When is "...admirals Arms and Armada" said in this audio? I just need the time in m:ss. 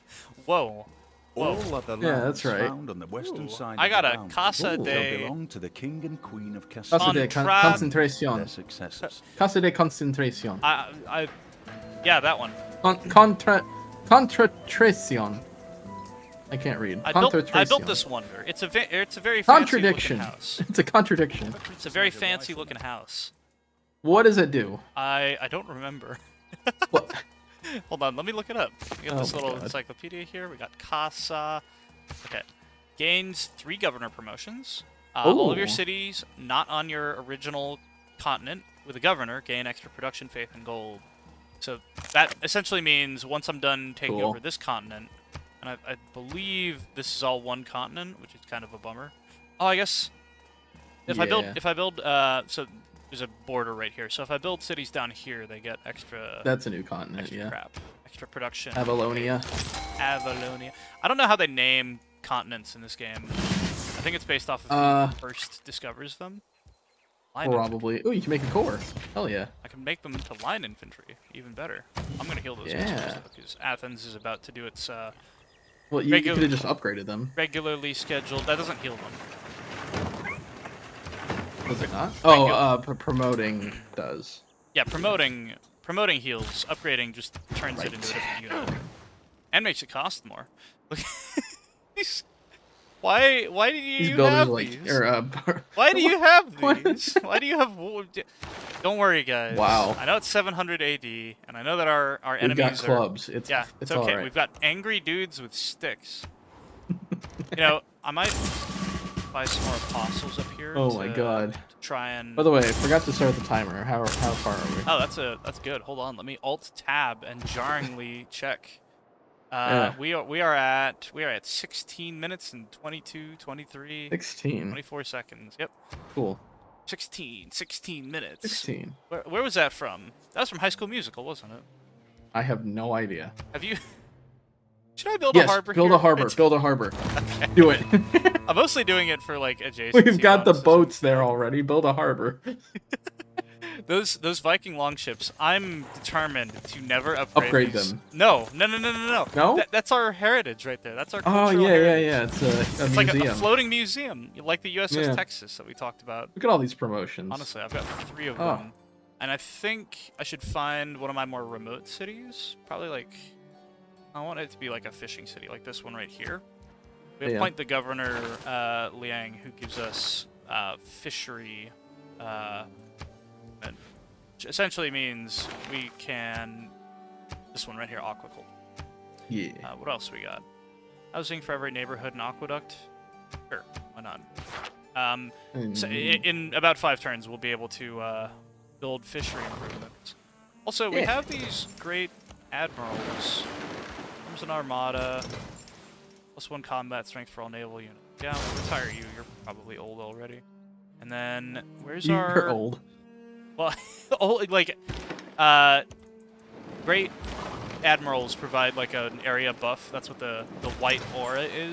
3:12.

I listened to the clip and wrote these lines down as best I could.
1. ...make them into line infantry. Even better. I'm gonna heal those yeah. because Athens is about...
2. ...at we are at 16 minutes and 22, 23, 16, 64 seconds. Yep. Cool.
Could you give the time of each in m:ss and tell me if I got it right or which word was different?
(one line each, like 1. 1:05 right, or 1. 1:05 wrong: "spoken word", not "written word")
1. 1:09 right
2. 2:00 wrong: "24", not "64".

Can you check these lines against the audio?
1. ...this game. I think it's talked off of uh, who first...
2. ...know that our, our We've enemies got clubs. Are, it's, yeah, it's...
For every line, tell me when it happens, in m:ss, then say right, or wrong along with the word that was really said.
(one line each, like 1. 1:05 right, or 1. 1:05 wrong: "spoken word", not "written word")
1. 1:02 wrong: "based", not "talked"
2. 1:41 right.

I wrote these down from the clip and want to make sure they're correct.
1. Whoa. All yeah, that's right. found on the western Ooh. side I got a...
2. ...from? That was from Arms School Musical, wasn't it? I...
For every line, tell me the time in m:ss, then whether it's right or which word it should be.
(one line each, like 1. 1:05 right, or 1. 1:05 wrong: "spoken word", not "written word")
1. 0:01 right
2. 2:09 wrong: "High", not "Arms".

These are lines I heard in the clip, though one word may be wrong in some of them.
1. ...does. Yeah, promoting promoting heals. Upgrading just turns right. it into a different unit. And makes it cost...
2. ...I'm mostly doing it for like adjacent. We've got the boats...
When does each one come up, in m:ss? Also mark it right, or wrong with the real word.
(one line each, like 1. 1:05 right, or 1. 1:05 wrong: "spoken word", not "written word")
1. 1:23 right
2. 2:18 right.